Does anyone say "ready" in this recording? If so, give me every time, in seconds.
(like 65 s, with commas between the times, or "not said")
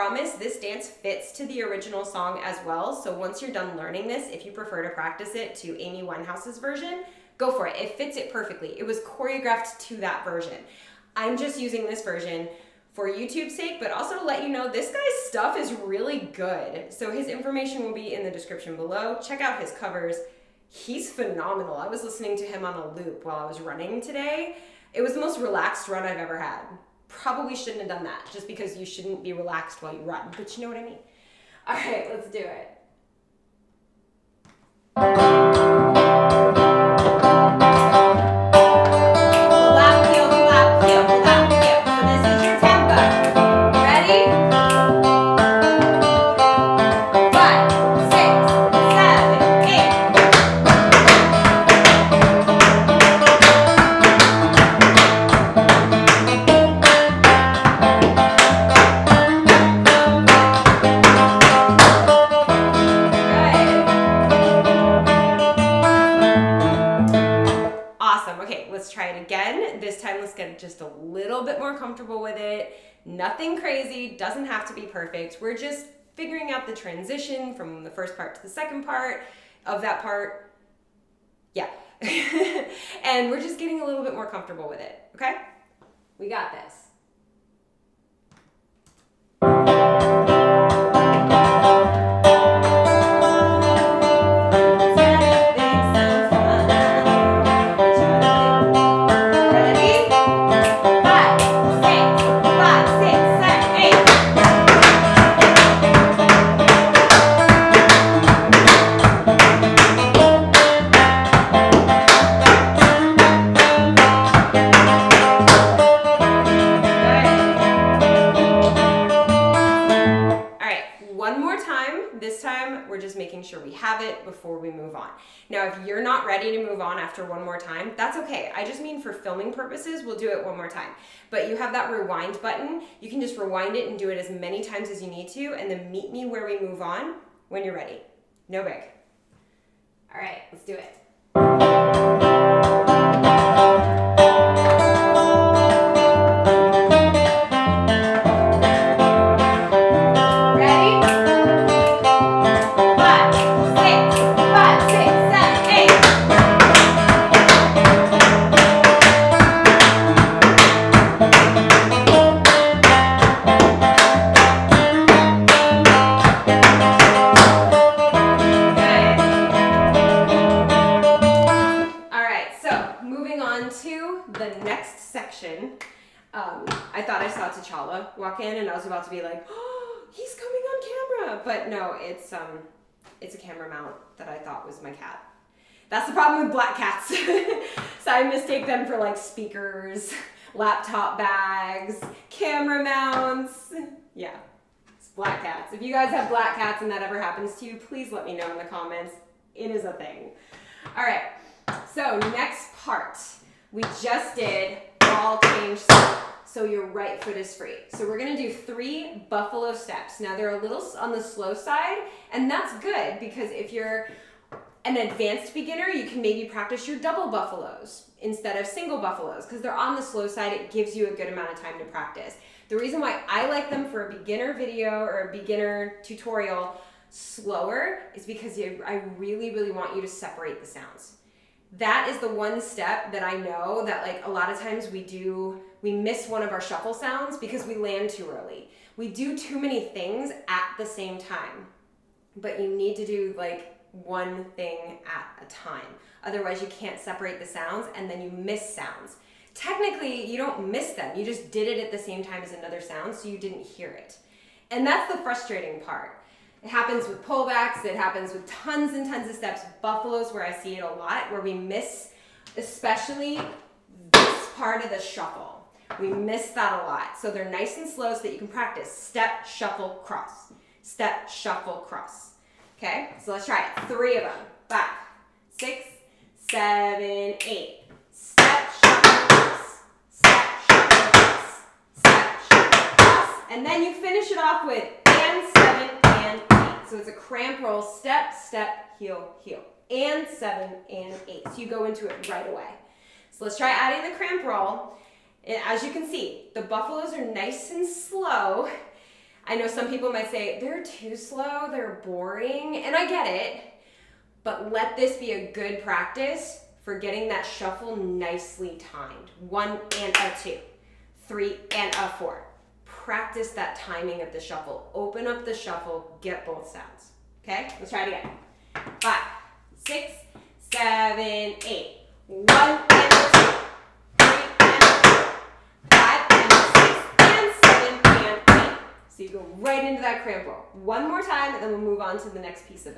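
126 s, 137 s.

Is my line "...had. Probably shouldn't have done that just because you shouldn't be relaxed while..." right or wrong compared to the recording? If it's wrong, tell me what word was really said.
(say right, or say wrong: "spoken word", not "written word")
right.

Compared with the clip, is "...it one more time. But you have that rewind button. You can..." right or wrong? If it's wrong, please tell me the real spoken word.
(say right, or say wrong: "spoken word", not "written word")
right.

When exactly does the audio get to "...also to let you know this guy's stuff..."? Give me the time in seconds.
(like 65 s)
13 s.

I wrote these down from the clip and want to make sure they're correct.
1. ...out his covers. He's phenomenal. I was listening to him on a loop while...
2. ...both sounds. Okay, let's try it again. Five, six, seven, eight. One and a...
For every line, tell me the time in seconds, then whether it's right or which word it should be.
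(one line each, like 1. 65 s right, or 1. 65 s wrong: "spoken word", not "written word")
1. 19 s right
2. 316 s right.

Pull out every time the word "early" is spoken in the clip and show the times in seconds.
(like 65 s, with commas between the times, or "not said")
238 s.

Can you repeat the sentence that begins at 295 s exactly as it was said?
And as you can see, the buffaloes are nice and slow.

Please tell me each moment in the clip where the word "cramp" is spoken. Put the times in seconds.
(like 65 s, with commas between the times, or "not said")
287 s, 294 s, 330 s.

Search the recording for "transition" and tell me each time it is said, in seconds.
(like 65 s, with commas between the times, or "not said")
76 s.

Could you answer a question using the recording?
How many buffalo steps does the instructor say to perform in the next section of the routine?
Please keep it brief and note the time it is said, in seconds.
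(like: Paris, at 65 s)
3, at 208 s.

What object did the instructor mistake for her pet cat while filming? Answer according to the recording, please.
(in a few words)
camera mount.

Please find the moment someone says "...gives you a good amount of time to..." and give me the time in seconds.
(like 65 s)
220 s.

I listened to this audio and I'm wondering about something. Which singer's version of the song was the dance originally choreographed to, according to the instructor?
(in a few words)
Amy Winehouse.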